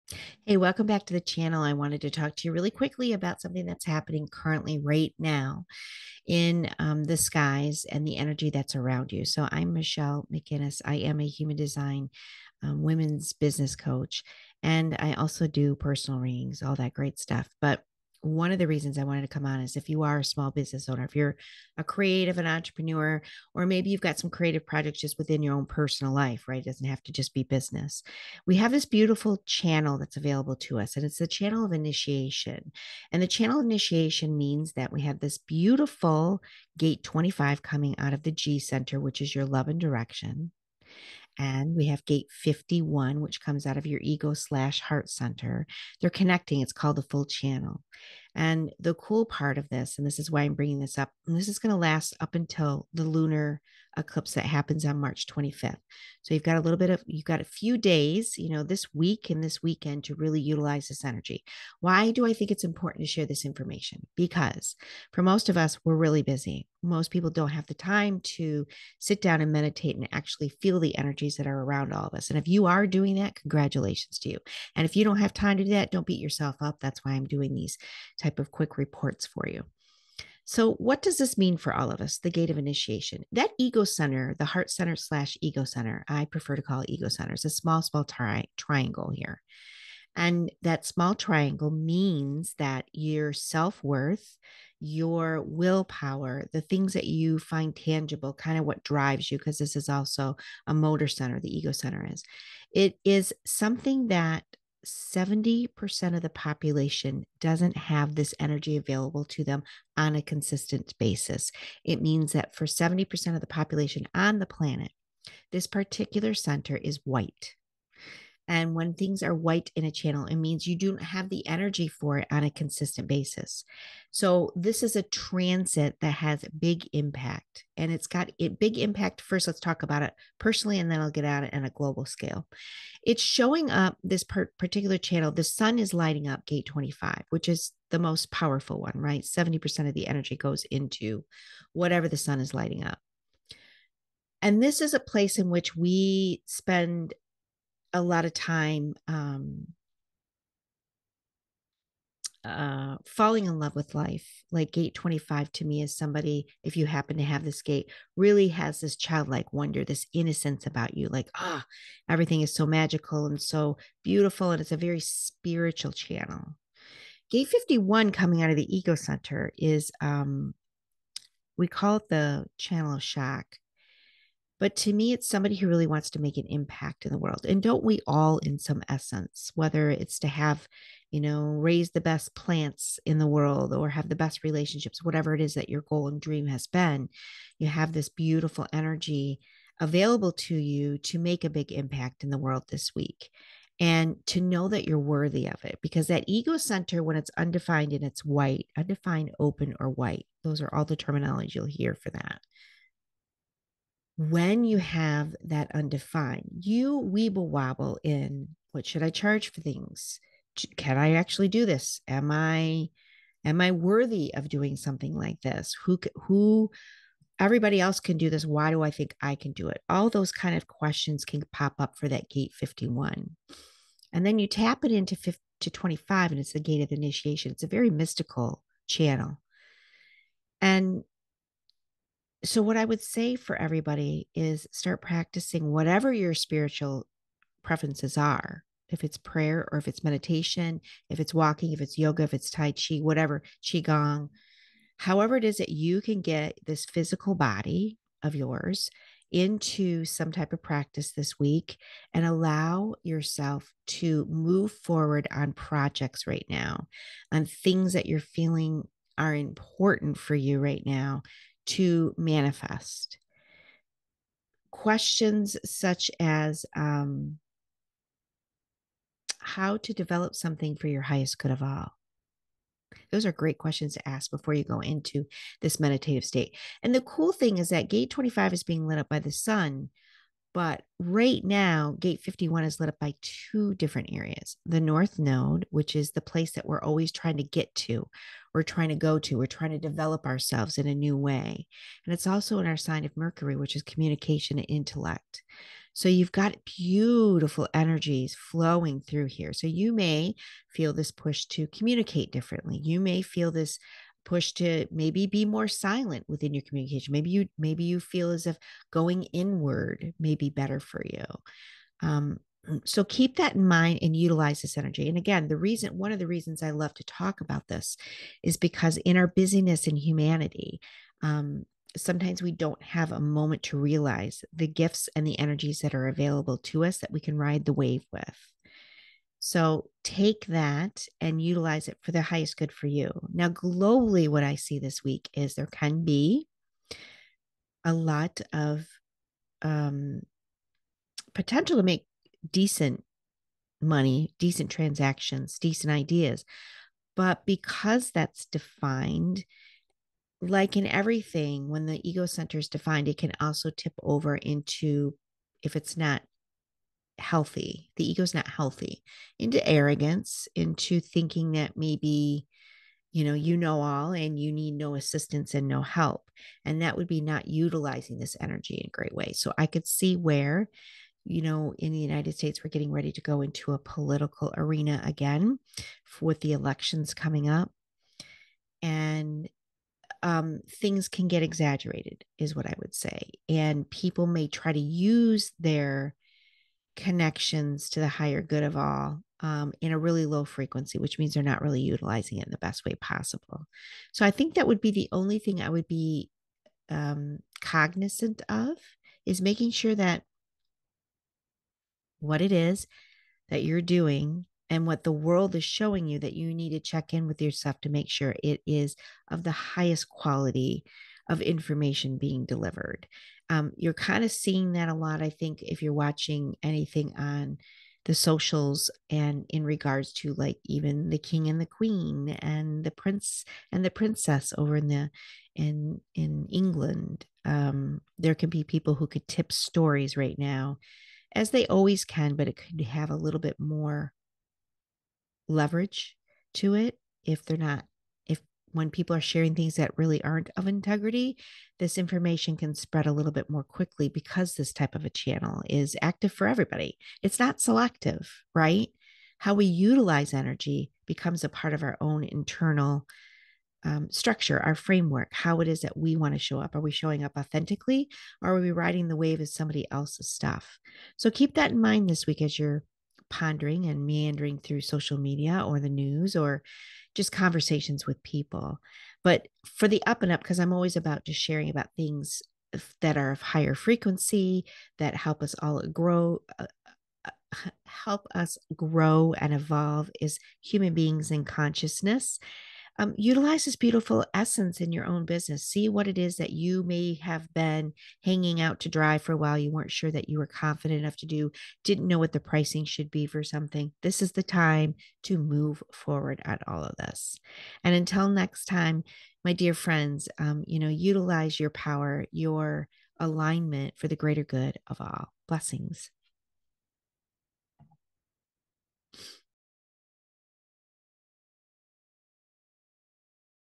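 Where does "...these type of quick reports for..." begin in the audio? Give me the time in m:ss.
1:17.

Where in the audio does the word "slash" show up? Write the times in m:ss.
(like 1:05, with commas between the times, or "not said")
0:44, 1:24.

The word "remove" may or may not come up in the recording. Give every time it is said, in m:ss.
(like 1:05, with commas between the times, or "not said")
not said.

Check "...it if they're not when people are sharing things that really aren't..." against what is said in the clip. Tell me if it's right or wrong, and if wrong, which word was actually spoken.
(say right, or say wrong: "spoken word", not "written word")
right.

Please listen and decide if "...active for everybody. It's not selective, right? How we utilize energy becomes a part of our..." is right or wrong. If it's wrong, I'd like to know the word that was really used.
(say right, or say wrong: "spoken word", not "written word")
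right.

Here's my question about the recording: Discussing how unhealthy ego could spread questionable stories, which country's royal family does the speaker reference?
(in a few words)
England.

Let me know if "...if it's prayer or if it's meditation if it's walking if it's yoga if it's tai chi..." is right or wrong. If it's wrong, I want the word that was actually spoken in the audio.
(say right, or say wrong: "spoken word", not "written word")
right.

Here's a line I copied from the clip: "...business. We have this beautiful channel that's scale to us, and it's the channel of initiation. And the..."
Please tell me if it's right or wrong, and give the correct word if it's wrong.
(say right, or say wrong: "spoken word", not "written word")
wrong: "available", not "scale".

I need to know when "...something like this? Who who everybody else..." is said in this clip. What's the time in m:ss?
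3:34.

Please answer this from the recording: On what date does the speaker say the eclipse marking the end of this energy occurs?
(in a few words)
March 25th.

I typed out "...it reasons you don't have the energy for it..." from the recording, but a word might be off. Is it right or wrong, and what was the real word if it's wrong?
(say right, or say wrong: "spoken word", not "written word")
wrong: "means", not "reasons".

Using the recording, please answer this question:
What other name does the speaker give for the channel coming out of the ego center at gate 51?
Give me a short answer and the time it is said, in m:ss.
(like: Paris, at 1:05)
channel of shock, at 2:52.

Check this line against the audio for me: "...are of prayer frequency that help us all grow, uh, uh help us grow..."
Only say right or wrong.
wrong.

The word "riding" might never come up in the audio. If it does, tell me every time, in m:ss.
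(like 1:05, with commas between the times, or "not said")
7:38.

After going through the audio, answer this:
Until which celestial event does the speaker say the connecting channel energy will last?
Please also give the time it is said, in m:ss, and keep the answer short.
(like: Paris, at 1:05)
lunar eclipse, at 0:53.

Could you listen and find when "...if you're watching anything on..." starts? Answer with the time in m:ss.
6:55.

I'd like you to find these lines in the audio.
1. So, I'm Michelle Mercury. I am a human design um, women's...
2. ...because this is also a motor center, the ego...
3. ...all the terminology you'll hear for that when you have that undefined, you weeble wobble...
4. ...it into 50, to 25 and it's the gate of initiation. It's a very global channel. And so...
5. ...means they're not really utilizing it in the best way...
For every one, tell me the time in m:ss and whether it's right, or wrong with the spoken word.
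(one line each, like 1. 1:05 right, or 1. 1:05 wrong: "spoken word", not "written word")
1. 0:09 wrong: "McInnis", not "Mercury"
2. 1:39 right
3. 3:20 right
4. 3:44 wrong: "mystical", not "global"
5. 6:31 right.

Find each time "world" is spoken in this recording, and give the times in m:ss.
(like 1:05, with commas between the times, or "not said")
2:57, 3:03, 3:12, 6:45.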